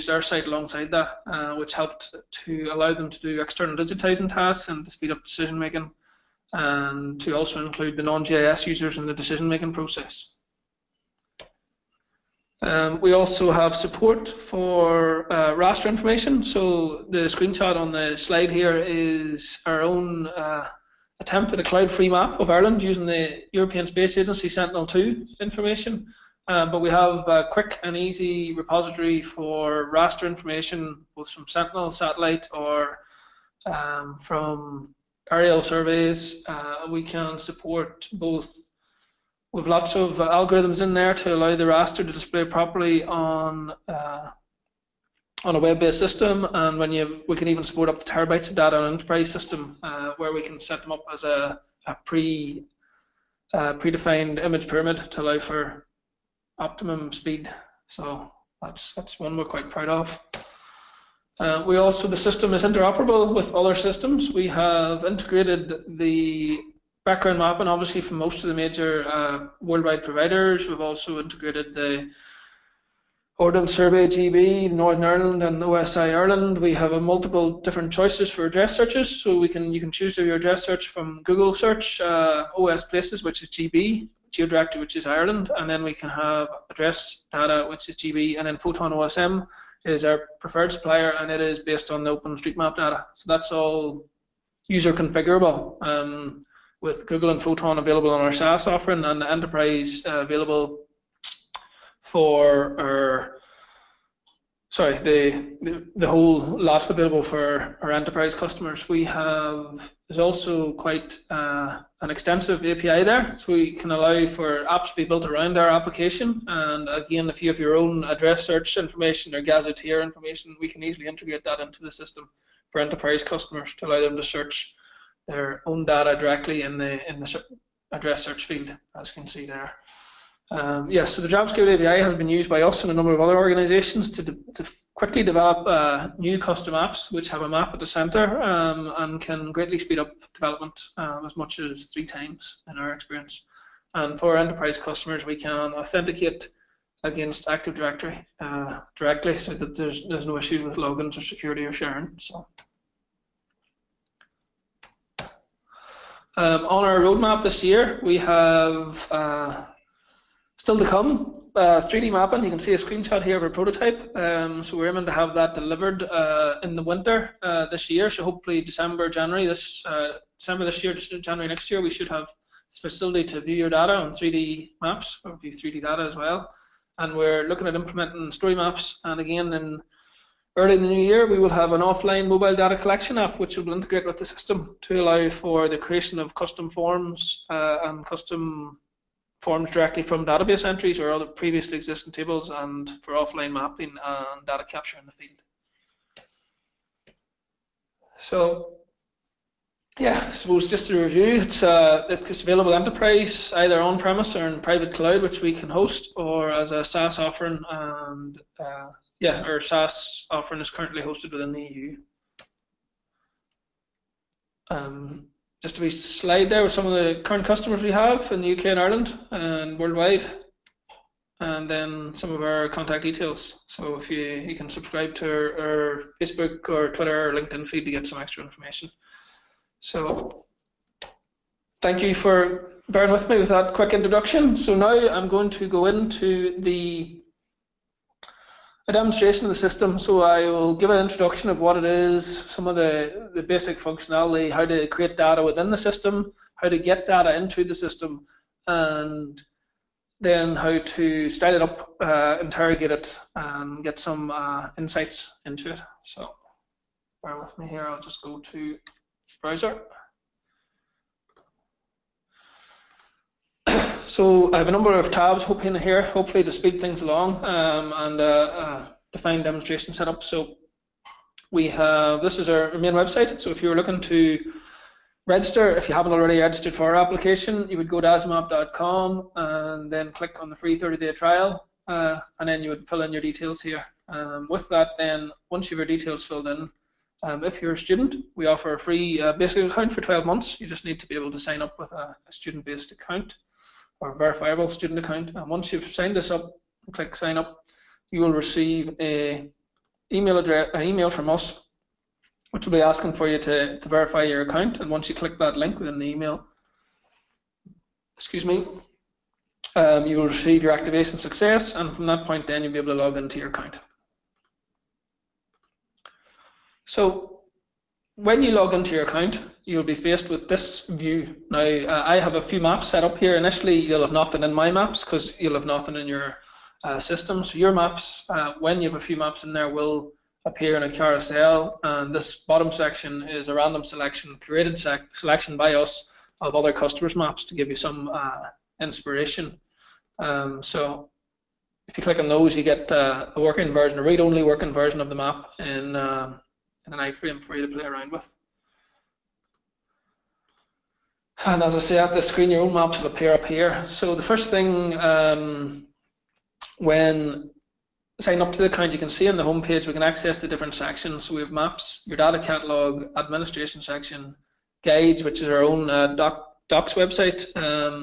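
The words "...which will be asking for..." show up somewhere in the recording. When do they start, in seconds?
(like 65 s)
302 s.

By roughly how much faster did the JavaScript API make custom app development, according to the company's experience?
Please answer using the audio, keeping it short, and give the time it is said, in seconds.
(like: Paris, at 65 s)
3 times, at 141 s.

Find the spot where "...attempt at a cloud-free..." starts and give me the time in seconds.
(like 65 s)
21 s.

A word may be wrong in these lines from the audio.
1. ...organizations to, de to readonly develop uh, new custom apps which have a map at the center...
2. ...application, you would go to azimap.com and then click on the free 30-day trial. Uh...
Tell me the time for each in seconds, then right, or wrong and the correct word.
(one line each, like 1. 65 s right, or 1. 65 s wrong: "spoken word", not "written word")
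1. 133 s wrong: "quickly", not "readonly"
2. 276 s right.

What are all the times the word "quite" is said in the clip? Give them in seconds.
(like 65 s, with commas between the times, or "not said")
59 s, 110 s.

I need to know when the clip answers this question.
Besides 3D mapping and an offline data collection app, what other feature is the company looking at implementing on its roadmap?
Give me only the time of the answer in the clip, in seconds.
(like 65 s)
178 s.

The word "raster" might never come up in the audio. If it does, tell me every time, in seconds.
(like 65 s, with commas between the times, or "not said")
15 s, 29 s, 41 s.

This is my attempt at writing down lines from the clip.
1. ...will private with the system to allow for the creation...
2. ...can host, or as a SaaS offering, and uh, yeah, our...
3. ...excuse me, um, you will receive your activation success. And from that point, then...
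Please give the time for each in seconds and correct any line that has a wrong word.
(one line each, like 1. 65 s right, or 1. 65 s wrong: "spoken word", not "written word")
1. 183 s wrong: "integrate", not "private"
2. 205 s right
3. 308 s right.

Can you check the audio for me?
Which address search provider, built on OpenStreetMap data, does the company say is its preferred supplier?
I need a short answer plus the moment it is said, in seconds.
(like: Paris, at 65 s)
Photon OSM, at 88 s.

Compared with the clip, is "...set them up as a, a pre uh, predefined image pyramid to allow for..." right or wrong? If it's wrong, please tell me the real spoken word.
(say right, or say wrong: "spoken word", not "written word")
right.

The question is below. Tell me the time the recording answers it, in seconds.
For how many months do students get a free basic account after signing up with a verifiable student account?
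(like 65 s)
290 s.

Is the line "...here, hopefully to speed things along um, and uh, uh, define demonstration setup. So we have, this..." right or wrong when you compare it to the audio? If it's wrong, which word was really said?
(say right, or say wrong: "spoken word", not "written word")
right.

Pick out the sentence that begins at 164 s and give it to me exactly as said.
Um, so we're aiming to have that delivered uh, in the winter uh, this year.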